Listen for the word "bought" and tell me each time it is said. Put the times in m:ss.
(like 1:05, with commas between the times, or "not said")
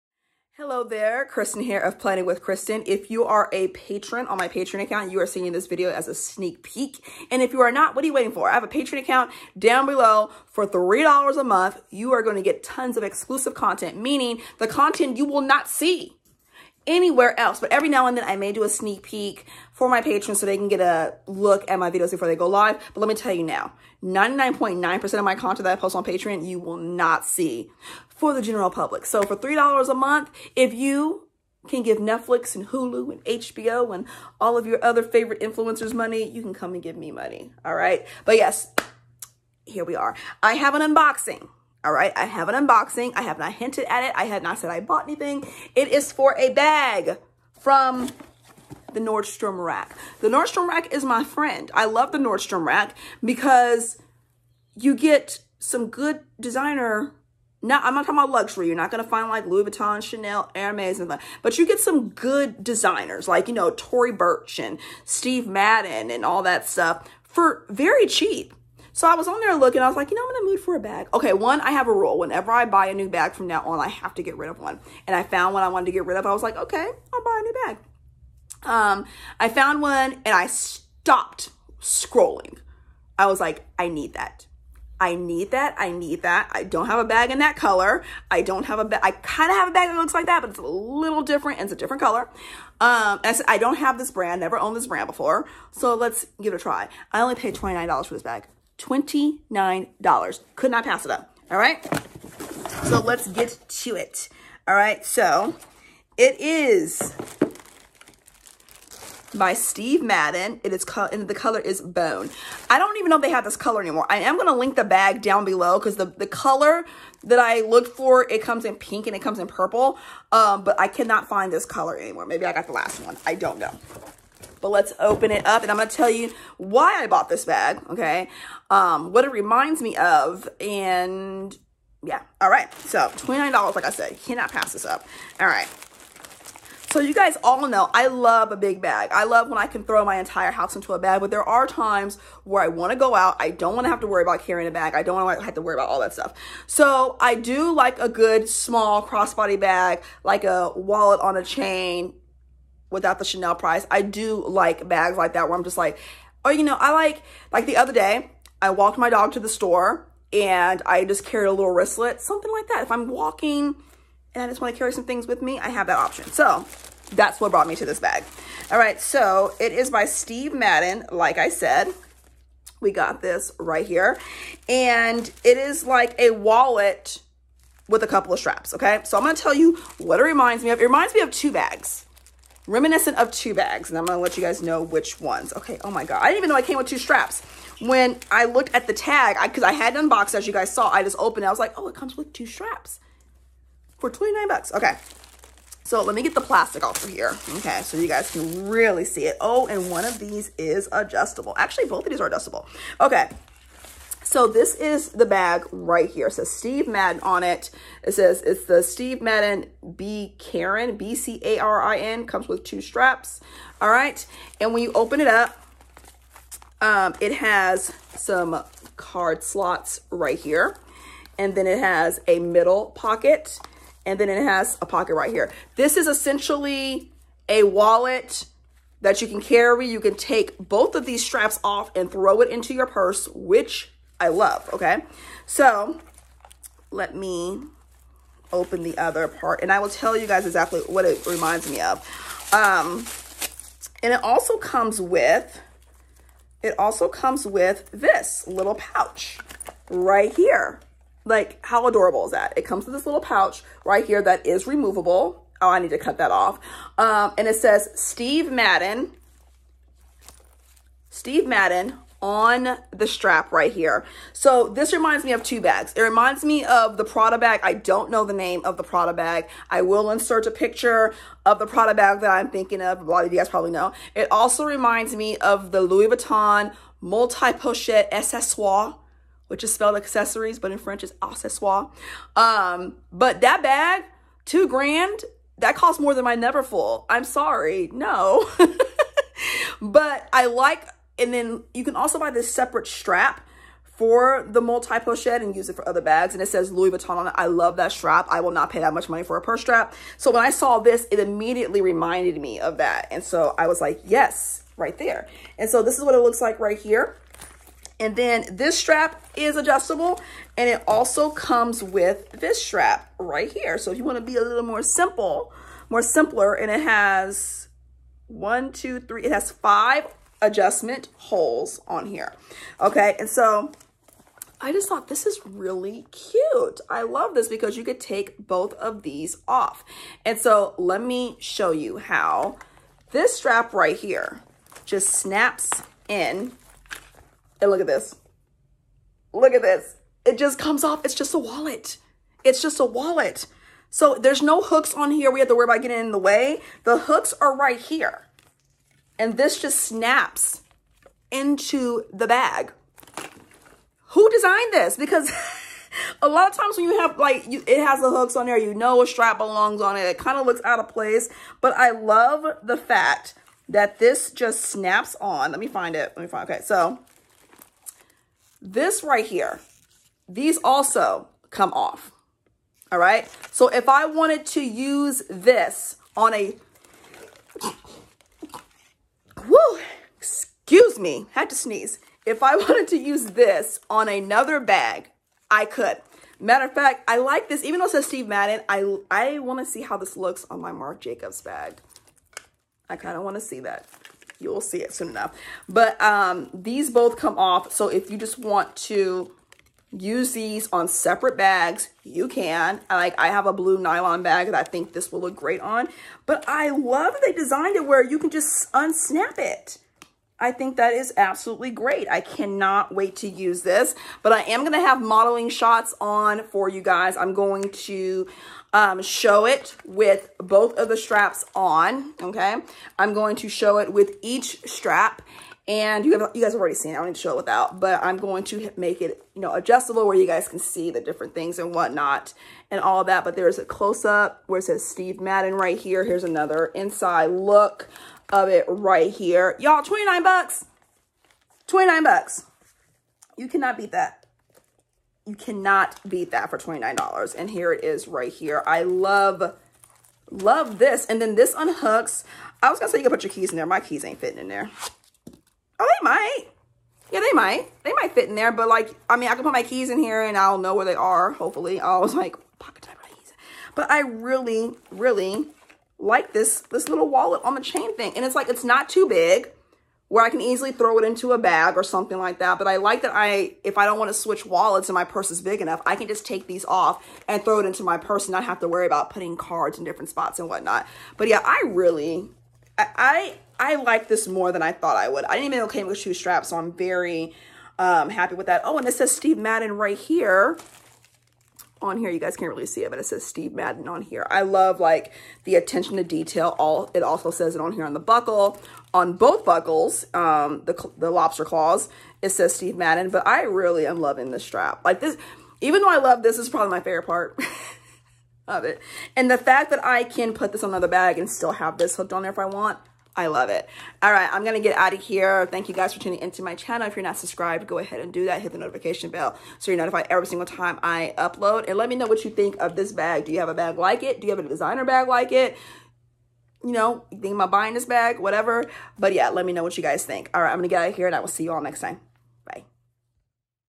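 0:44, 2:07.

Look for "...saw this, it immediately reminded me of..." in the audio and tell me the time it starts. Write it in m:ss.
5:00.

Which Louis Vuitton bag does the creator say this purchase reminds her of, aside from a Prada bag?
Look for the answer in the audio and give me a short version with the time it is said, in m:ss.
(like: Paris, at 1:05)
Multi-pochette accessoire, at 4:37.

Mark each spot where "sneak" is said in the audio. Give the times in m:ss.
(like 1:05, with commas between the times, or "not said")
0:06, 0:18.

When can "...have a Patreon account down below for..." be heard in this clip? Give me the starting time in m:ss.
0:08.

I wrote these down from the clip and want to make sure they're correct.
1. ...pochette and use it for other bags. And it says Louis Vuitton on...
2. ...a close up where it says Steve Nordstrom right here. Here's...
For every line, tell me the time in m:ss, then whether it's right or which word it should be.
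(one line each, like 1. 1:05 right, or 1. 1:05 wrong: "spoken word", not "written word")
1. 4:54 right
2. 7:13 wrong: "Madden", not "Nordstrom".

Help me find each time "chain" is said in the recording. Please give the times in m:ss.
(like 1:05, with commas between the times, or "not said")
2:31, 7:47.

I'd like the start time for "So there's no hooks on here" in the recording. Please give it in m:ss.
5:43.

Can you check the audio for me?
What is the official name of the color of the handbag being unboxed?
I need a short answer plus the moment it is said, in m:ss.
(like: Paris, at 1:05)
Bone, at 1:51.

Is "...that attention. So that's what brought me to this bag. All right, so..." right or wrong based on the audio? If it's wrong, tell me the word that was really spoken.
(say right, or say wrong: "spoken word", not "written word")
wrong: "option", not "attention".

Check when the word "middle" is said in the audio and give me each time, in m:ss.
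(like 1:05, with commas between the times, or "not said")
3:42.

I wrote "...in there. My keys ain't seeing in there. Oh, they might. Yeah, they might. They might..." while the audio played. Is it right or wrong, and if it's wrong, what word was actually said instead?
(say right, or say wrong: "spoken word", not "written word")
wrong: "fitting", not "seeing".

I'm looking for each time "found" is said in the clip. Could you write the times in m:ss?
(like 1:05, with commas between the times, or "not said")
1:15, 1:19.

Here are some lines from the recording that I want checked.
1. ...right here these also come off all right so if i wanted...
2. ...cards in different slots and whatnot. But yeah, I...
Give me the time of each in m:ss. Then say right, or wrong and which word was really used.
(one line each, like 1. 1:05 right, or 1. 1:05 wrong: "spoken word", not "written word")
1. 6:09 right
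2. 7:59 wrong: "spots", not "slots".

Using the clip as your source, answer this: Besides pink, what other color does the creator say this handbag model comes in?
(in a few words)
Purple.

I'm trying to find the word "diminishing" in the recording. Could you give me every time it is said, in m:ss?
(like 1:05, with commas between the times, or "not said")
not said.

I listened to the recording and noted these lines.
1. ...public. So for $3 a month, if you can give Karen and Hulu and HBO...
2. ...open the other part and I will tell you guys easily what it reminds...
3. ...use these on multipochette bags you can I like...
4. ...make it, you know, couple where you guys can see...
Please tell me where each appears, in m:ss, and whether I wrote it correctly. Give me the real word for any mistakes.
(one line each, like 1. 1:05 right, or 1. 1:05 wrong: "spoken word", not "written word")
1. 0:28 wrong: "Netflix", not "Karen"
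2. 3:58 wrong: "exactly", not "easily"
3. 6:39 wrong: "separate", not "multipochette"
4. 7:08 wrong: "adjustable", not "couple".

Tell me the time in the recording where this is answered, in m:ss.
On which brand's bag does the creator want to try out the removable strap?
6:30.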